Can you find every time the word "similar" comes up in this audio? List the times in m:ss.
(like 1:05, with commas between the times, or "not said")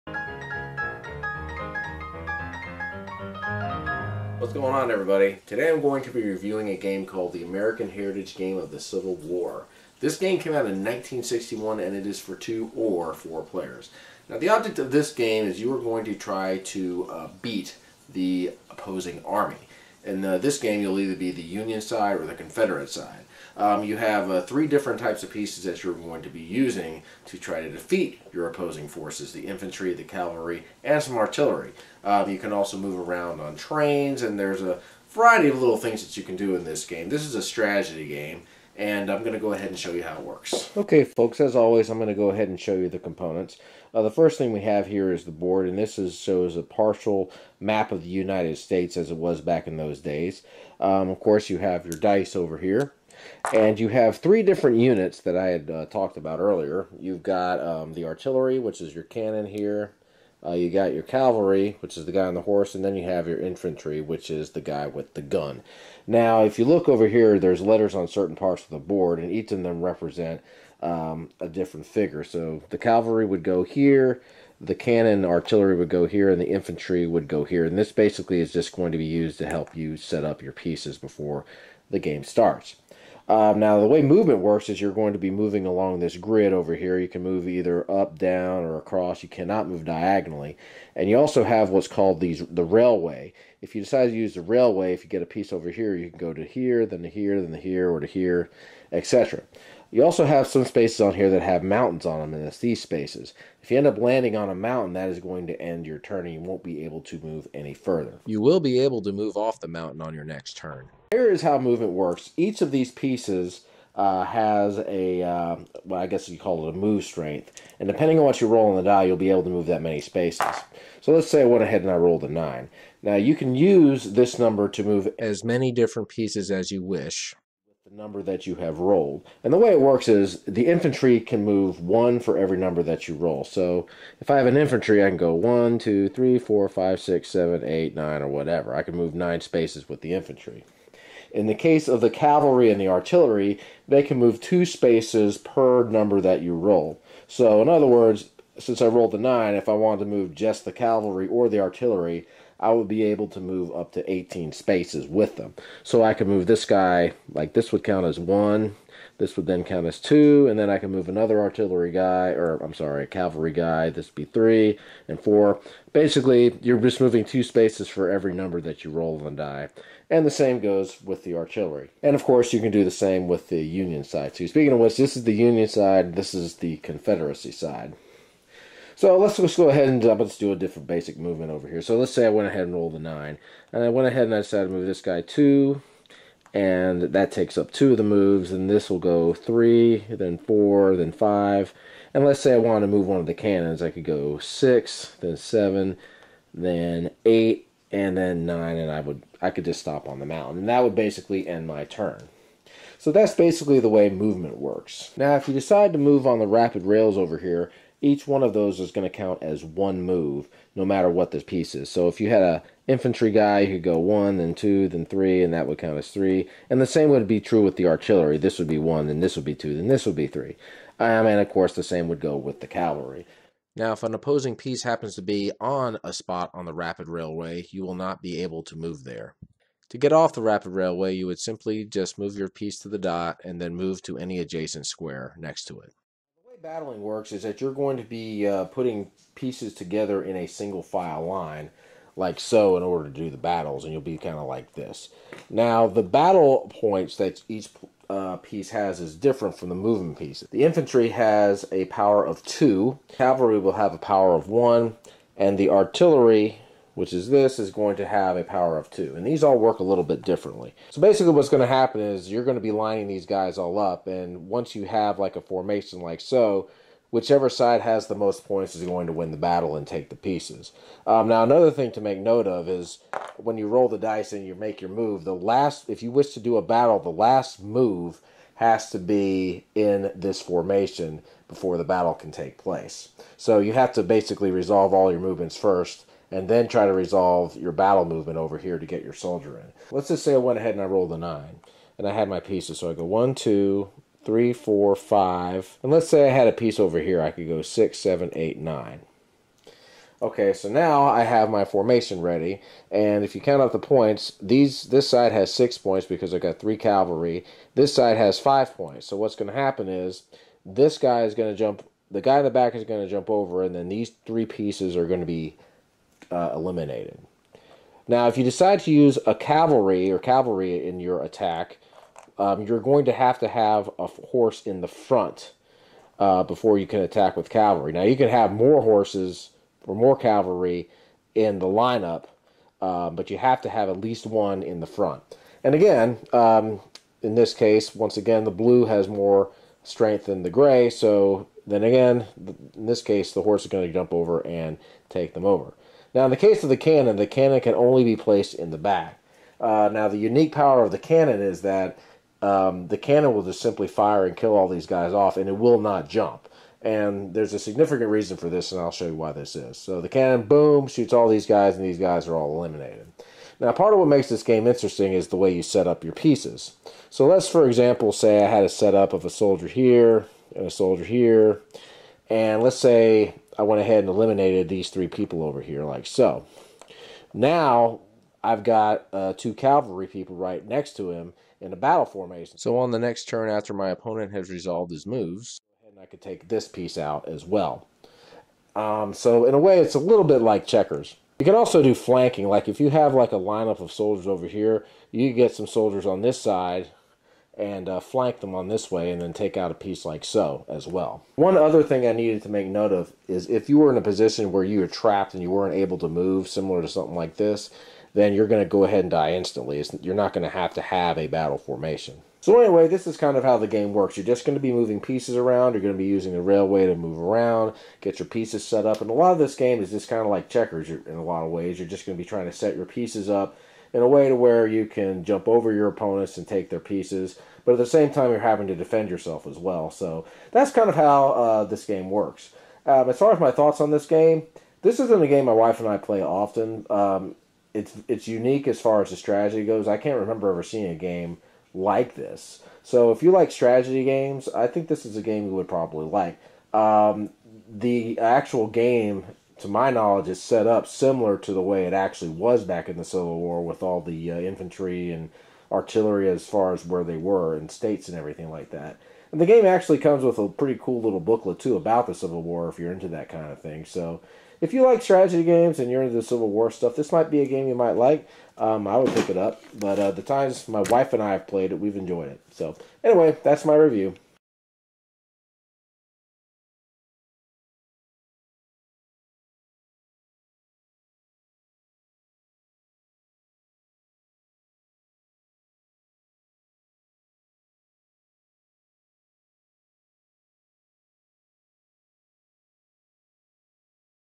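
6:46, 7:30.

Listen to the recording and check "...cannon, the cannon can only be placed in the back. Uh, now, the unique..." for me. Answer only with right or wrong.
right.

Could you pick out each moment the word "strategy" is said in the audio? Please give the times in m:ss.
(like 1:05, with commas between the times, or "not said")
0:37, 7:19, 7:23, 7:45.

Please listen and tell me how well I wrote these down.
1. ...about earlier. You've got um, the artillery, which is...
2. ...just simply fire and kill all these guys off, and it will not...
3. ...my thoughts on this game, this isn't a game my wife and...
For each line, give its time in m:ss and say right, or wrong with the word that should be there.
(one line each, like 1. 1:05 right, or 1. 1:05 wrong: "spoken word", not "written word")
1. 0:56 right
2. 5:53 right
3. 7:13 right.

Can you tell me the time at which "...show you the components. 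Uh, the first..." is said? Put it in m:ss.
0:42.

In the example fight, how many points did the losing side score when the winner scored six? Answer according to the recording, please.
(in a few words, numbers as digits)
5.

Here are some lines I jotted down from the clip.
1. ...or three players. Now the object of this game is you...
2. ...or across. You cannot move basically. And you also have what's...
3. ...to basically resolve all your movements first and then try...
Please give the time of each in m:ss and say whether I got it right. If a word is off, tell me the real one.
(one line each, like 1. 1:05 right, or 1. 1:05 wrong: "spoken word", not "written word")
1. 0:12 wrong: "four", not "three"
2. 1:28 wrong: "diagonally", not "basically"
3. 4:43 right.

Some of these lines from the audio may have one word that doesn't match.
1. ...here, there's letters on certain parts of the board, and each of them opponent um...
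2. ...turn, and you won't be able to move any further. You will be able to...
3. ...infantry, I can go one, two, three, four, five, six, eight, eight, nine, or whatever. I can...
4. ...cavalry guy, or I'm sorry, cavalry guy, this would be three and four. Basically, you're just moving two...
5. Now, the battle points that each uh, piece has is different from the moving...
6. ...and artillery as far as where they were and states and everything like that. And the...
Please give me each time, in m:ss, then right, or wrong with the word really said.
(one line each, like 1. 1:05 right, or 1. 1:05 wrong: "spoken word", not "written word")
1. 1:07 wrong: "represent", not "opponent"
2. 1:45 right
3. 2:14 wrong: "seven", not "eight"
4. 2:41 wrong: "artillery", not "cavalry"
5. 4:05 right
6. 7:35 right.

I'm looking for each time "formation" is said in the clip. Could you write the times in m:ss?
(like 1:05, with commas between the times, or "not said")
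4:25, 4:40, 5:01, 6:22, 6:51.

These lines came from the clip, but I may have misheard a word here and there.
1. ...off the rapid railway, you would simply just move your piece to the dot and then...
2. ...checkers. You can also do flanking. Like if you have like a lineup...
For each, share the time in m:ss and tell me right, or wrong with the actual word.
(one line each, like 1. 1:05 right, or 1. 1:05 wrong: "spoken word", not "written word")
1. 3:50 right
2. 6:30 right.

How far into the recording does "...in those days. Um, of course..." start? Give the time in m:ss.
0:49.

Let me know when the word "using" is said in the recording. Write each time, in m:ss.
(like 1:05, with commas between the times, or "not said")
0:26, 6:56.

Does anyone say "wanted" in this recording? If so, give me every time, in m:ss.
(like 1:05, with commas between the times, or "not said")
2:29, 3:12.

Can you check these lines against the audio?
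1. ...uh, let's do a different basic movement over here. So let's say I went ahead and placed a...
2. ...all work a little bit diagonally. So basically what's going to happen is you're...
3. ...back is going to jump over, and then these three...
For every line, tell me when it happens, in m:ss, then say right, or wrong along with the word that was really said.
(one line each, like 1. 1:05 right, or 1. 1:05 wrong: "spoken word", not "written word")
1. 3:00 wrong: "rolled", not "placed"
2. 4:19 wrong: "differently", not "diagonally"
3. 5:12 right.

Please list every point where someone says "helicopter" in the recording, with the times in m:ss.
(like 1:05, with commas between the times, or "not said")
not said.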